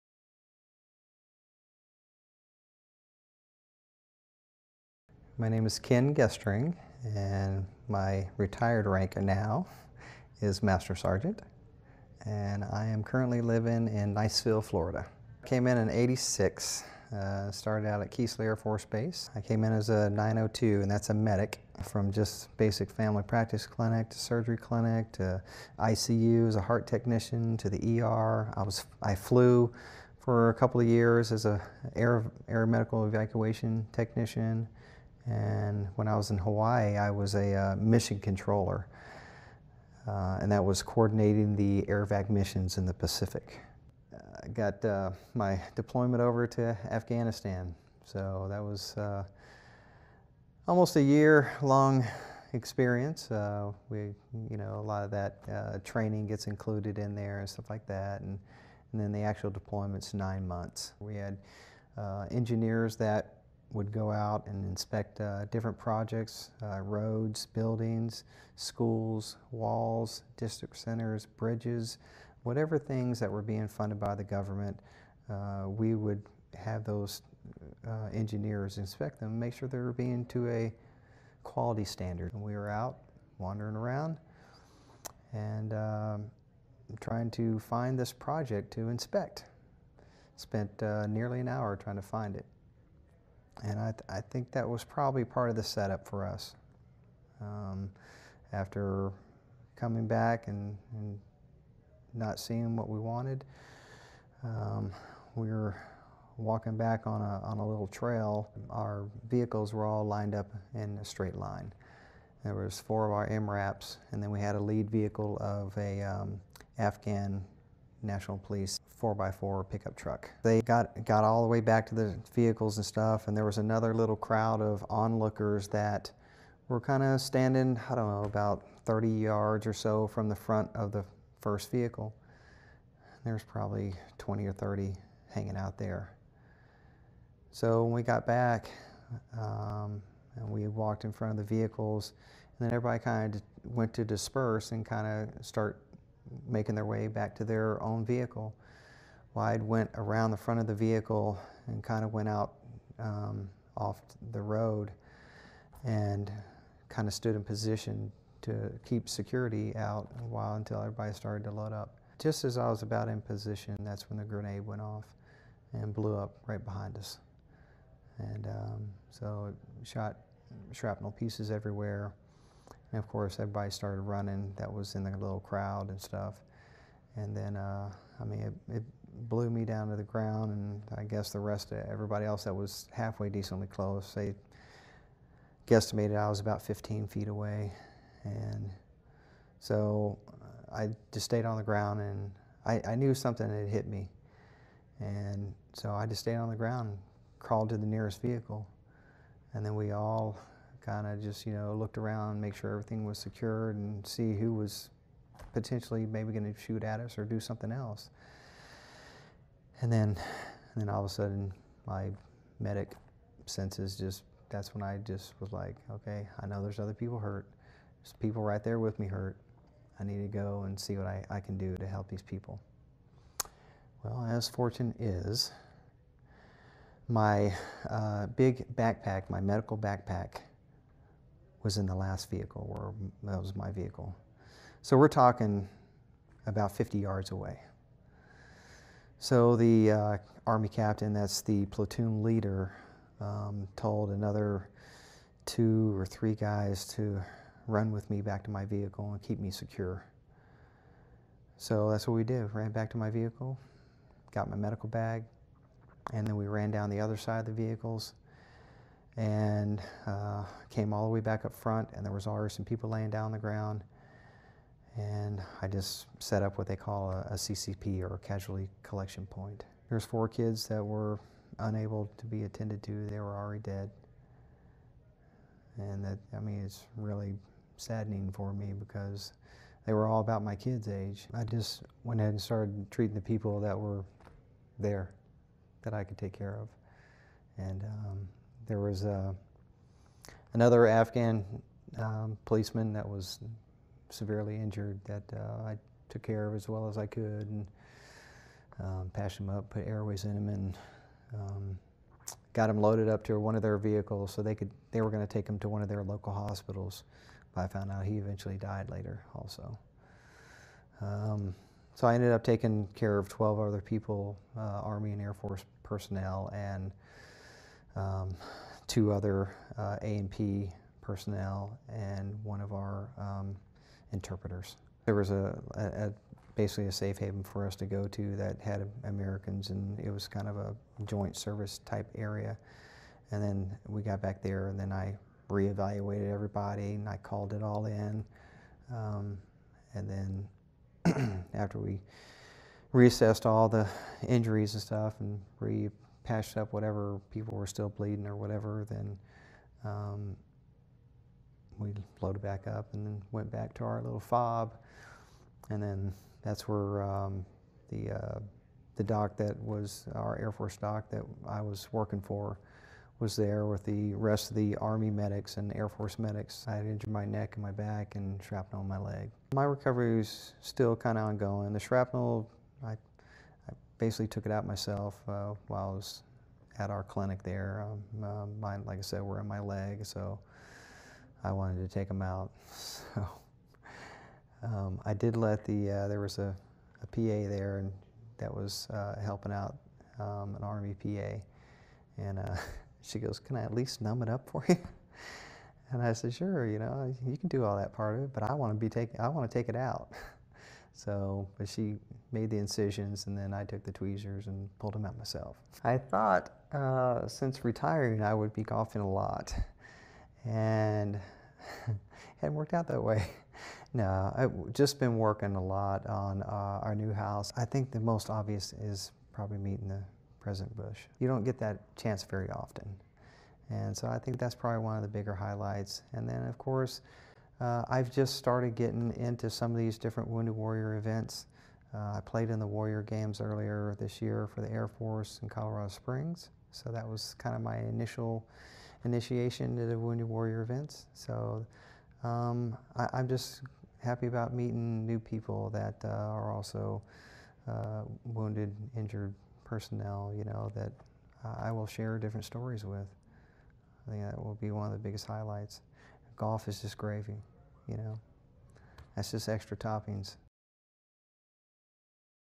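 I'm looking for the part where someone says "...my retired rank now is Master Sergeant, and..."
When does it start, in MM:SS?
00:07.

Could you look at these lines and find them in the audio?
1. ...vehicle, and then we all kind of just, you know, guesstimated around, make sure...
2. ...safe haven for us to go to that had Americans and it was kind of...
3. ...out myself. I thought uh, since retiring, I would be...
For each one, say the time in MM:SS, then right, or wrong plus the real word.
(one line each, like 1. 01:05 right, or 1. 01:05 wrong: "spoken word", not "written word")
1. 03:18 wrong: "looked", not "guesstimated"
2. 05:26 right
3. 06:45 right.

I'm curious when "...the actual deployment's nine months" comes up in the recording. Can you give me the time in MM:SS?
00:59.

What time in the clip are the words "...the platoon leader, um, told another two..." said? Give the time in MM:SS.
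04:01.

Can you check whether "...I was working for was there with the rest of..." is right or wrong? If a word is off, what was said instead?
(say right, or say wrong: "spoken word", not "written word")
right.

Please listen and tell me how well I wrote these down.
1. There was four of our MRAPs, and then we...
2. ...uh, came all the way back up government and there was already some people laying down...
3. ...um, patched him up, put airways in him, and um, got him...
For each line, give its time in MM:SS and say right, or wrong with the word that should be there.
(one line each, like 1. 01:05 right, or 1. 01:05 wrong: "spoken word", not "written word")
1. 01:52 right
2. 04:20 wrong: "front", not "government"
3. 04:58 right.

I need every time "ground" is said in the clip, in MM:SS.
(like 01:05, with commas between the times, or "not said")
03:00, 03:11, 03:16, 04:23.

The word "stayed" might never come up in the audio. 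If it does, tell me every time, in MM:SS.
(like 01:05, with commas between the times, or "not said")
03:11, 03:16.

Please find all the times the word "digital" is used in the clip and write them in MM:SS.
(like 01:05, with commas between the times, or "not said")
not said.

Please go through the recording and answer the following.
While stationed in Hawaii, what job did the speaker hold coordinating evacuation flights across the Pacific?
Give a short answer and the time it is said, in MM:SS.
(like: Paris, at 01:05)
Mission controller, at 00:37.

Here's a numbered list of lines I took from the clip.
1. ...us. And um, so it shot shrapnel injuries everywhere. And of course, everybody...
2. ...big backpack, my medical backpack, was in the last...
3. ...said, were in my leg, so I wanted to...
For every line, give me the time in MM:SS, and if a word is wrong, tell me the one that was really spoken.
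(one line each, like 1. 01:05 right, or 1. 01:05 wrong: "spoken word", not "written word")
1. 02:46 wrong: "pieces", not "injuries"
2. 03:48 right
3. 06:19 right.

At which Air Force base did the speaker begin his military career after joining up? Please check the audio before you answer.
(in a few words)
Keesler Air Force Base.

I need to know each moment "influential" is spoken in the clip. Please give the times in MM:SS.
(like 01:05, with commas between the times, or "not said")
not said.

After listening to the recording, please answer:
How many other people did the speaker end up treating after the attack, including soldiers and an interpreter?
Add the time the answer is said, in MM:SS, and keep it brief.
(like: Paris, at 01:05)
12, at 05:13.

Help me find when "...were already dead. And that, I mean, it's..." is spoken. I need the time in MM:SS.
04:33.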